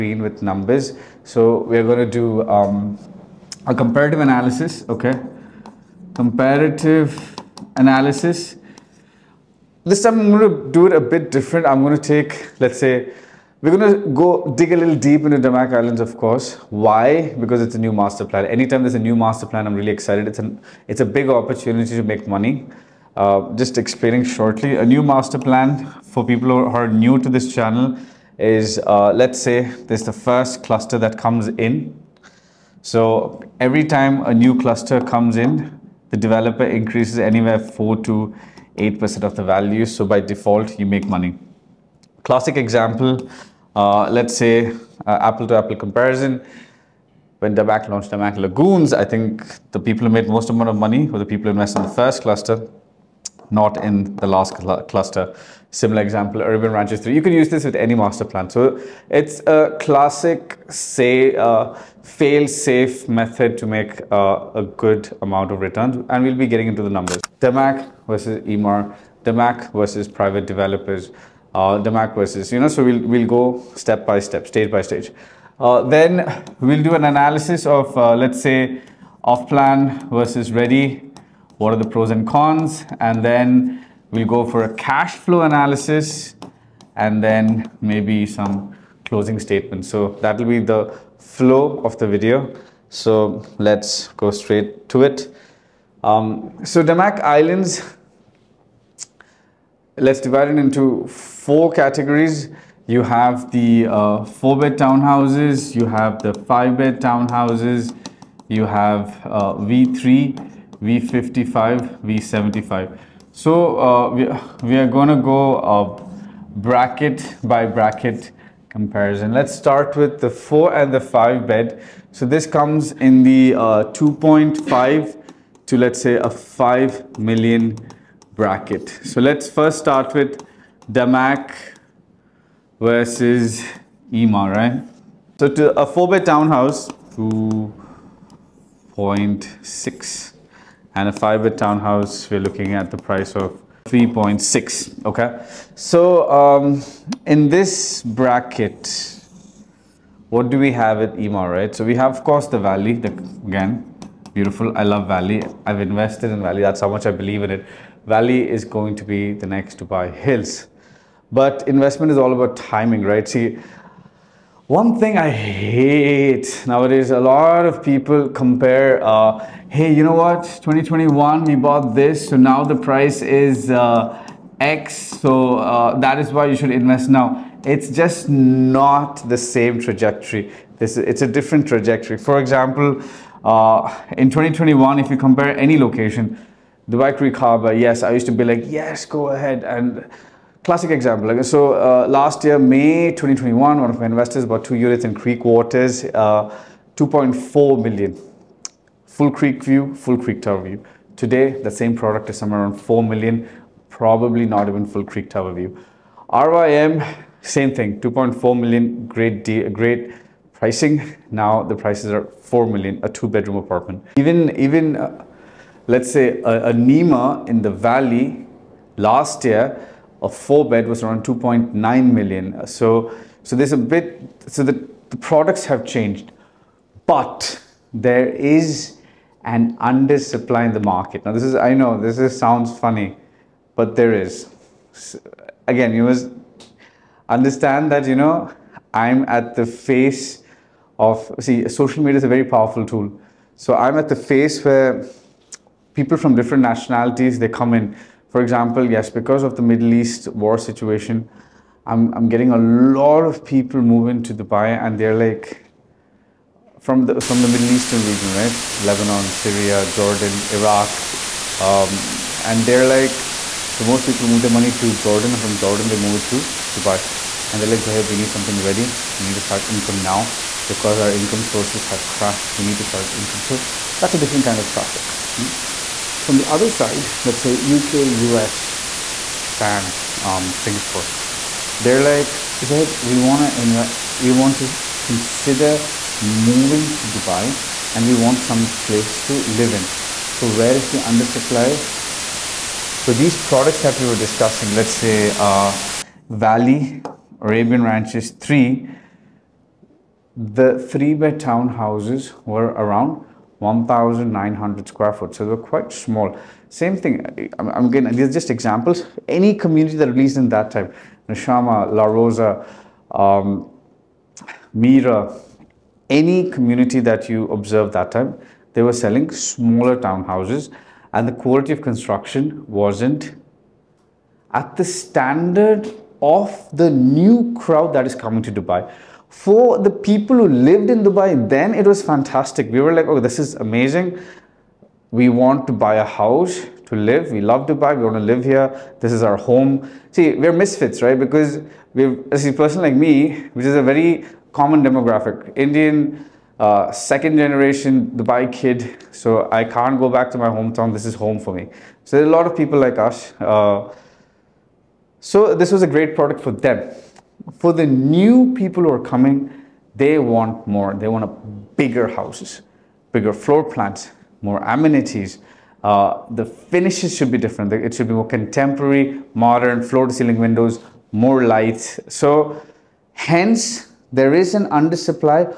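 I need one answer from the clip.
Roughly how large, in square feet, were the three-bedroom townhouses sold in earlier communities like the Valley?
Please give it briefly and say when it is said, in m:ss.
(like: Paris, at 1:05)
1,900 square feet, at 5:03.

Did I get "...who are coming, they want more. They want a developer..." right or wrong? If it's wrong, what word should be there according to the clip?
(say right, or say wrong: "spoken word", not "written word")
wrong: "bigger", not "developer".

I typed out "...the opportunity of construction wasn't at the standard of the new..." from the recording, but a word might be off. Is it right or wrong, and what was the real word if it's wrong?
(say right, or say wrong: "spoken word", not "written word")
wrong: "quality", not "opportunity".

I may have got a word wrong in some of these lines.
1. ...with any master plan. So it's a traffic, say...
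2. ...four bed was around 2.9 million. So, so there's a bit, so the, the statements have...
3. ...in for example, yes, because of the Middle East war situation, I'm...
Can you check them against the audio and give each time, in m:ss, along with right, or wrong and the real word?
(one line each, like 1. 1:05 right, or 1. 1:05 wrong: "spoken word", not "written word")
1. 0:57 wrong: "classic", not "traffic"
2. 3:40 wrong: "products", not "statements"
3. 4:07 right.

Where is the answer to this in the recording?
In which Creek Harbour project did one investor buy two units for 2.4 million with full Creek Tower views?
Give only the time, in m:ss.
3:15.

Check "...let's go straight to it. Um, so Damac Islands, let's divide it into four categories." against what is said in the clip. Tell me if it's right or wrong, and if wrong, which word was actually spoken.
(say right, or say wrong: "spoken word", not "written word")
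right.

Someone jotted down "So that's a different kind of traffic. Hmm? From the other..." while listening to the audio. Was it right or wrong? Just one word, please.
right.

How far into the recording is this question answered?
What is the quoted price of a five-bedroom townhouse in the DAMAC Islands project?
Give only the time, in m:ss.
2:23.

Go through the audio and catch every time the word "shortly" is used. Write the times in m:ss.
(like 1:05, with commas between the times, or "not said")
0:24.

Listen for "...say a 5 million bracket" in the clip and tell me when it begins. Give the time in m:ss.
2:06.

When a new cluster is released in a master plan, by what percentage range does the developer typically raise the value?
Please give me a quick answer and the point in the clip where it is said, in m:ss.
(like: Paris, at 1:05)
4 to 8%, at 0:37.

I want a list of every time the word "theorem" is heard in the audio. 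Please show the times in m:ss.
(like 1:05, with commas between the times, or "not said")
not said.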